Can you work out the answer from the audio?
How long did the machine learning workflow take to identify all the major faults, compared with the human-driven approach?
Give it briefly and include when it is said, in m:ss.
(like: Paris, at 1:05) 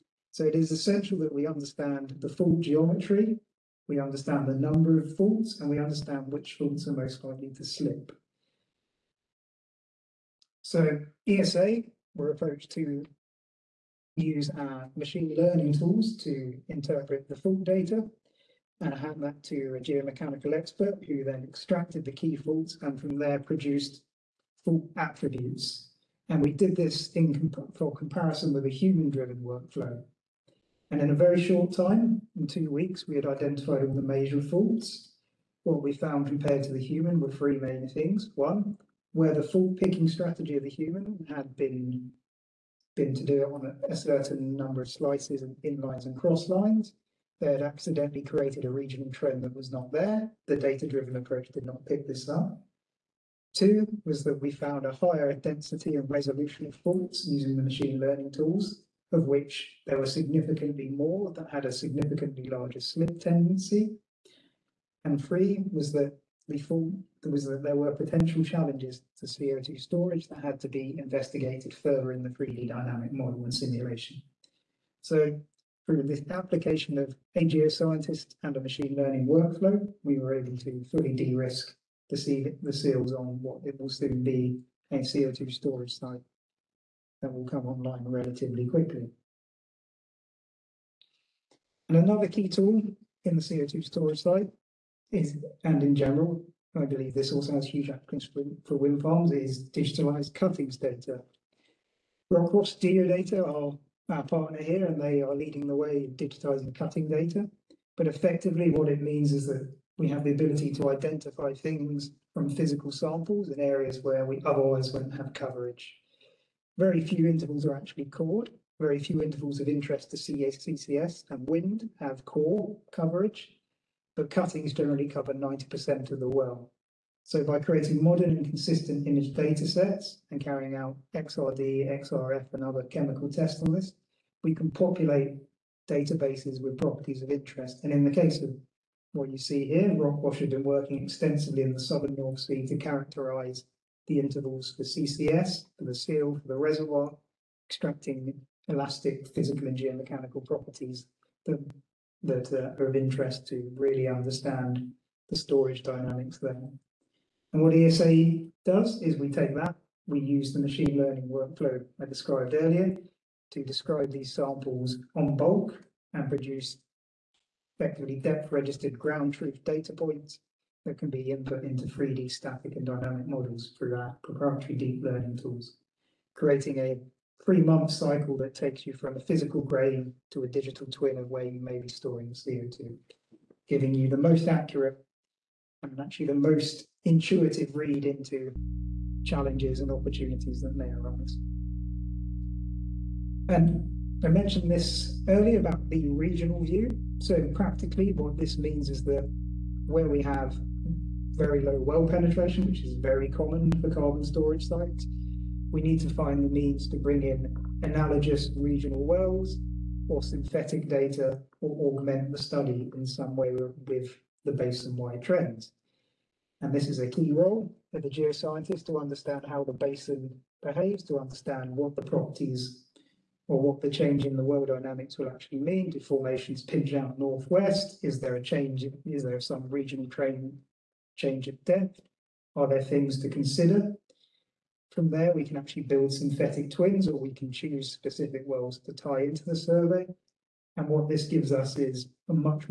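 2 weeks, at 0:32.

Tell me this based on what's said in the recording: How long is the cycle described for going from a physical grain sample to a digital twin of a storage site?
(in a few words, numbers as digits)
3 months.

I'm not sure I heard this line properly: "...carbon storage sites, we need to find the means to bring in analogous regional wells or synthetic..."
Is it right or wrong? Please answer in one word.
right.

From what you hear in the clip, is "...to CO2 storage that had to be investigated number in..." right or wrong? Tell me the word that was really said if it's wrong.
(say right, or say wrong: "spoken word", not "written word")
wrong: "further", not "number".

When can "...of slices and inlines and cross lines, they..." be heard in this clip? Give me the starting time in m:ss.
0:44.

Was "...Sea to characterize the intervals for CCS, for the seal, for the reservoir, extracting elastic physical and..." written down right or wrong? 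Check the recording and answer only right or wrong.
right.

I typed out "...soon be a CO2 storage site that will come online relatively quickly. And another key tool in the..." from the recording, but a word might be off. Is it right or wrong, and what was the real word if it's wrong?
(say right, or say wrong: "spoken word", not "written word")
right.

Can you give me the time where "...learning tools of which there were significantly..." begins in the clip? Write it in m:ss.
0:58.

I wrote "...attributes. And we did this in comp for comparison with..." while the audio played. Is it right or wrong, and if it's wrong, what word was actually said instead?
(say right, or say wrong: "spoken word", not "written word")
right.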